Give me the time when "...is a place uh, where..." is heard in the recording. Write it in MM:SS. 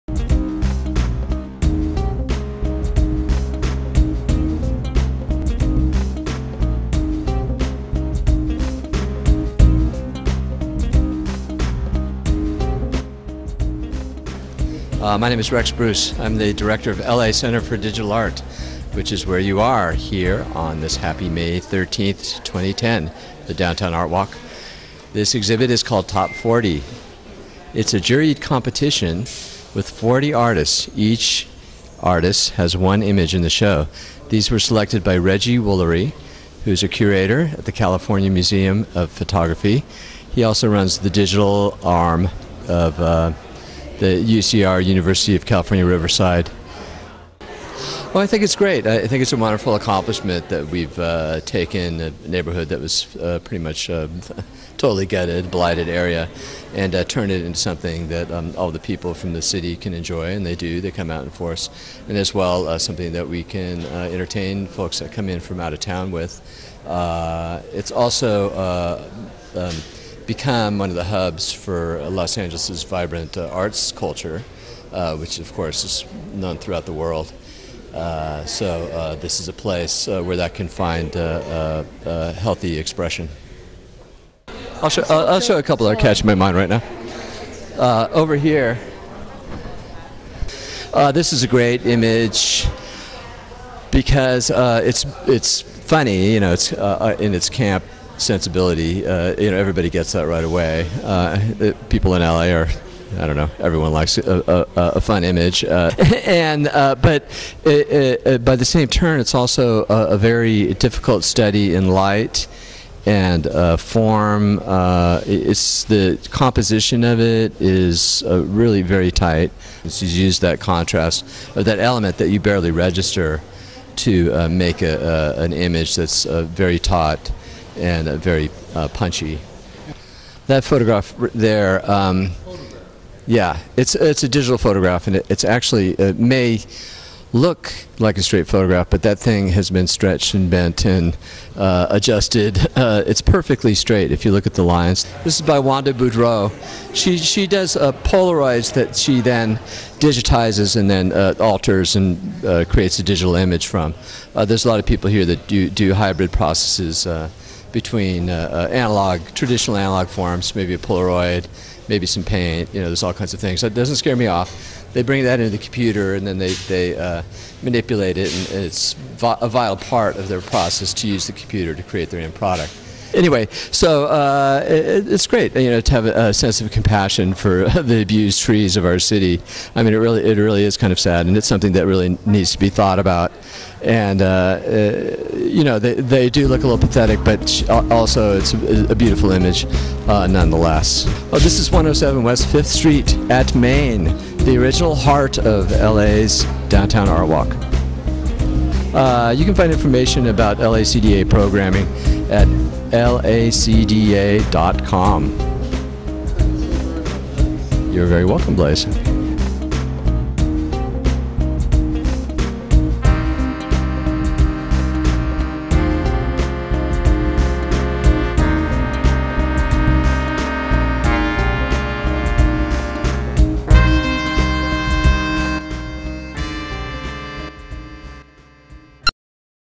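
01:19.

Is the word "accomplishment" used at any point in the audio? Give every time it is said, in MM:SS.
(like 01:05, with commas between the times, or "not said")
00:49.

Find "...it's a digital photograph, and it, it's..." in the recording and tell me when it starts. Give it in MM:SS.
02:13.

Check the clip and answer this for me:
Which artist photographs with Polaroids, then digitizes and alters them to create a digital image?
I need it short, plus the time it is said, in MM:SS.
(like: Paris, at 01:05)
Wanda Boudreau, at 02:25.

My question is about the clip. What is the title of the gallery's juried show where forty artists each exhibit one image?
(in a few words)
Top 40.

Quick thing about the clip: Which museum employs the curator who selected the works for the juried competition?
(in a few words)
California Museum of Photography.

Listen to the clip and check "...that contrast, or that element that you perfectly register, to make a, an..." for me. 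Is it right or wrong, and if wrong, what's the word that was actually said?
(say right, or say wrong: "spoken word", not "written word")
wrong: "barely", not "perfectly".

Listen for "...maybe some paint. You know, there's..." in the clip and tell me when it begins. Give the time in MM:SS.
02:41.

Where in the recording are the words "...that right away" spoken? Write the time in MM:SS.
01:40.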